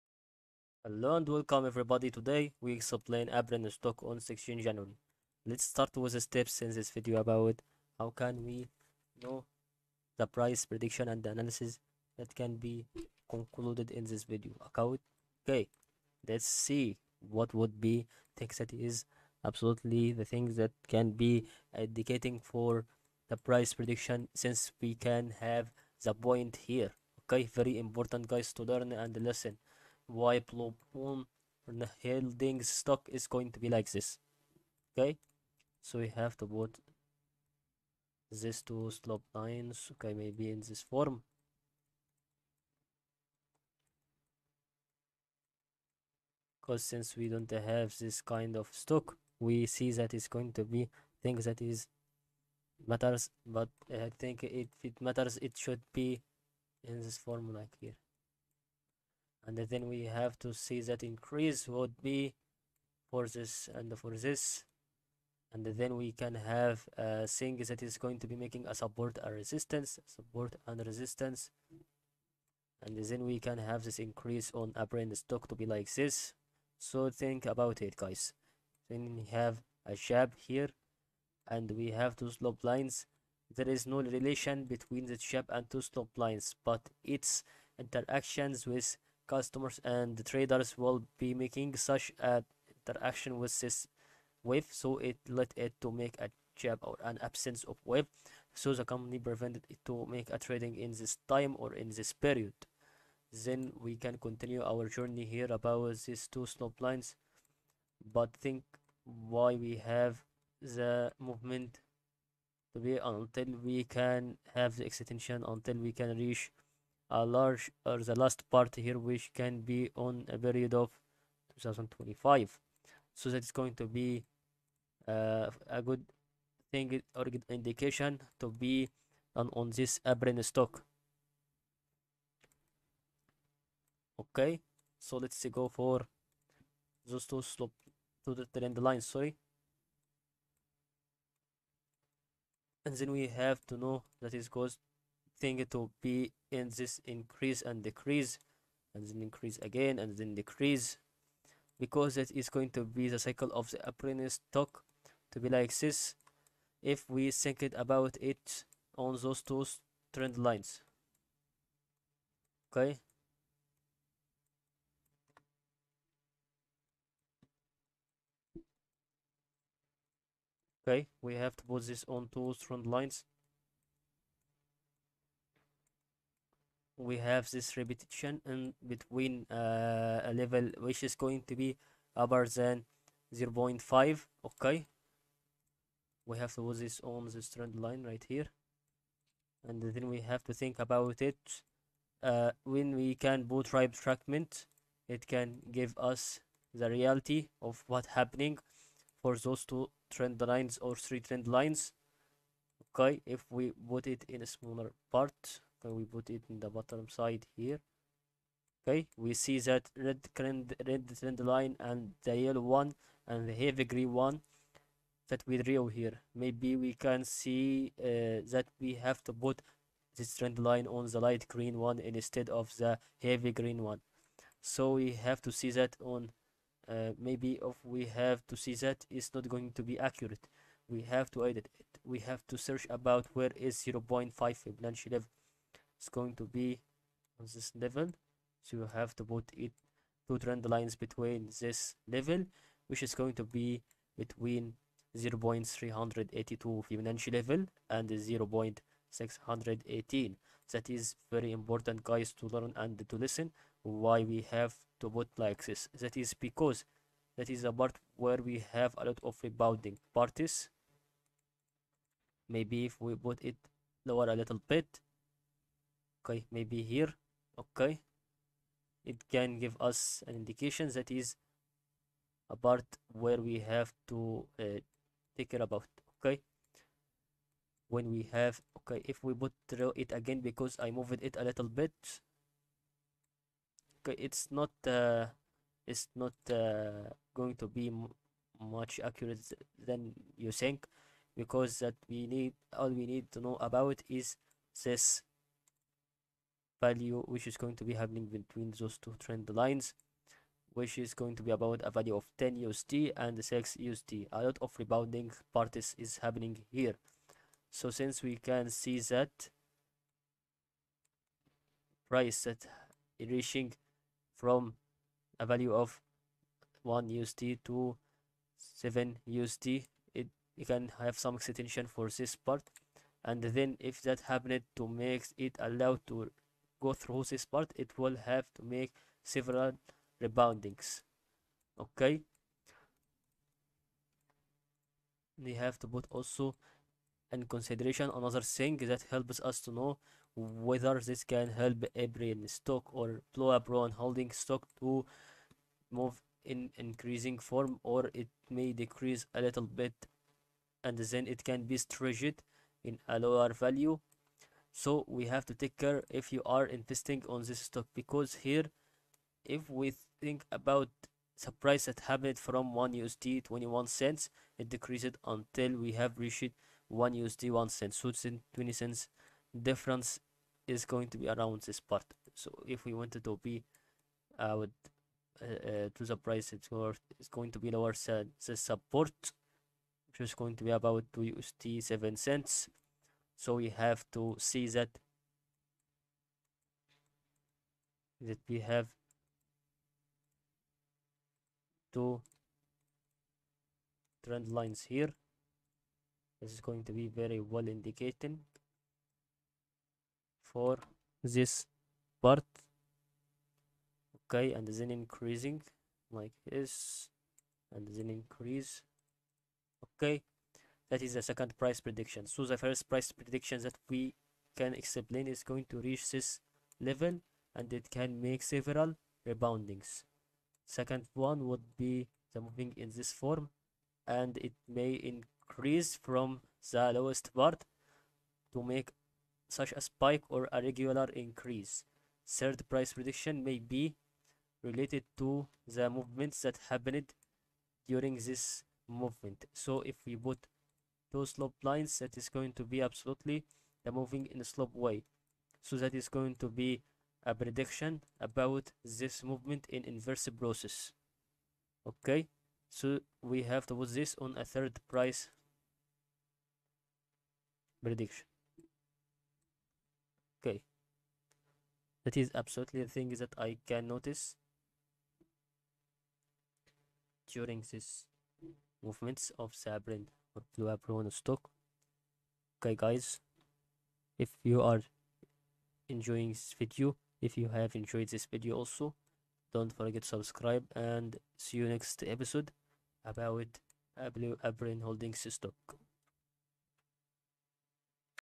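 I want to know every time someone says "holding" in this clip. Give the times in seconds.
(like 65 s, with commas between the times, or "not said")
32 s, 344 s, 484 s.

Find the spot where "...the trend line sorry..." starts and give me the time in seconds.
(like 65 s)
138 s.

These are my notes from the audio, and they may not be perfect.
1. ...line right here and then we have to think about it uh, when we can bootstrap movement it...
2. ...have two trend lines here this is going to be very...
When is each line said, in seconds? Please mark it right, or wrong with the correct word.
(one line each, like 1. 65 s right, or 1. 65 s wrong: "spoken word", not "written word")
1. 187 s wrong: "fragment", not "movement"
2. 388 s right.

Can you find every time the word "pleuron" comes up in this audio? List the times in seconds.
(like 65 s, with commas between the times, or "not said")
343 s.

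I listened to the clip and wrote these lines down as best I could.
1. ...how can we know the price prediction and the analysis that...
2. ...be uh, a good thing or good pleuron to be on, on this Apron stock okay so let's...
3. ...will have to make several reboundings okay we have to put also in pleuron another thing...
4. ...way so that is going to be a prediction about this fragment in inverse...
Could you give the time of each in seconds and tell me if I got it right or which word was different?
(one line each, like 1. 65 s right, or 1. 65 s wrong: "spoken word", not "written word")
1. 7 s right
2. 123 s wrong: "indication", not "pleuron"
3. 327 s wrong: "consideration", not "pleuron"
4. 444 s wrong: "movement", not "fragment".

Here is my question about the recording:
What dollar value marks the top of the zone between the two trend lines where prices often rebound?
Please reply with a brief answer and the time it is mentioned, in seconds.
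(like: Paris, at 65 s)
10 USD, at 302 s.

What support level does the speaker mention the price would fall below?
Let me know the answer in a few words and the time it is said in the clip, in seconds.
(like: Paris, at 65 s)
2 USD 7 cents, at 381 s.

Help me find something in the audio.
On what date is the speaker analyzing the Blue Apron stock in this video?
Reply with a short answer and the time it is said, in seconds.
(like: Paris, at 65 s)
16 January, at 4 s.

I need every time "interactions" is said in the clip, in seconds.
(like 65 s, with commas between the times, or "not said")
87 s, 92 s.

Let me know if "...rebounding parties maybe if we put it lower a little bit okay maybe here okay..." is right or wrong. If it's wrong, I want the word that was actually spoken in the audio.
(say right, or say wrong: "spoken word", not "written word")
right.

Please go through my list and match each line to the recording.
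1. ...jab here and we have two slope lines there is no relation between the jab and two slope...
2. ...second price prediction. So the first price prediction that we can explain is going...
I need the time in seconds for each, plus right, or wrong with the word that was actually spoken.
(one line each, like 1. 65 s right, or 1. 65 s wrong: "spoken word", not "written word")
1. 79 s right
2. 411 s right.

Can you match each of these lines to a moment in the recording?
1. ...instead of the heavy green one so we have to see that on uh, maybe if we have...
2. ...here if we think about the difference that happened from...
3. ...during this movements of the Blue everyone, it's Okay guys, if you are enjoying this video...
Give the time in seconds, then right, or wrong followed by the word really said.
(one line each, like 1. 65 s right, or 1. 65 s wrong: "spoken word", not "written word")
1. 221 s right
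2. 358 s wrong: "price", not "difference"
3. 467 s right.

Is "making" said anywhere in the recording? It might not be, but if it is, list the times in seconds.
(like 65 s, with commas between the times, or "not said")
68 s, 91 s.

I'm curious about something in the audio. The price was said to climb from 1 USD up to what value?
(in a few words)
7 USD.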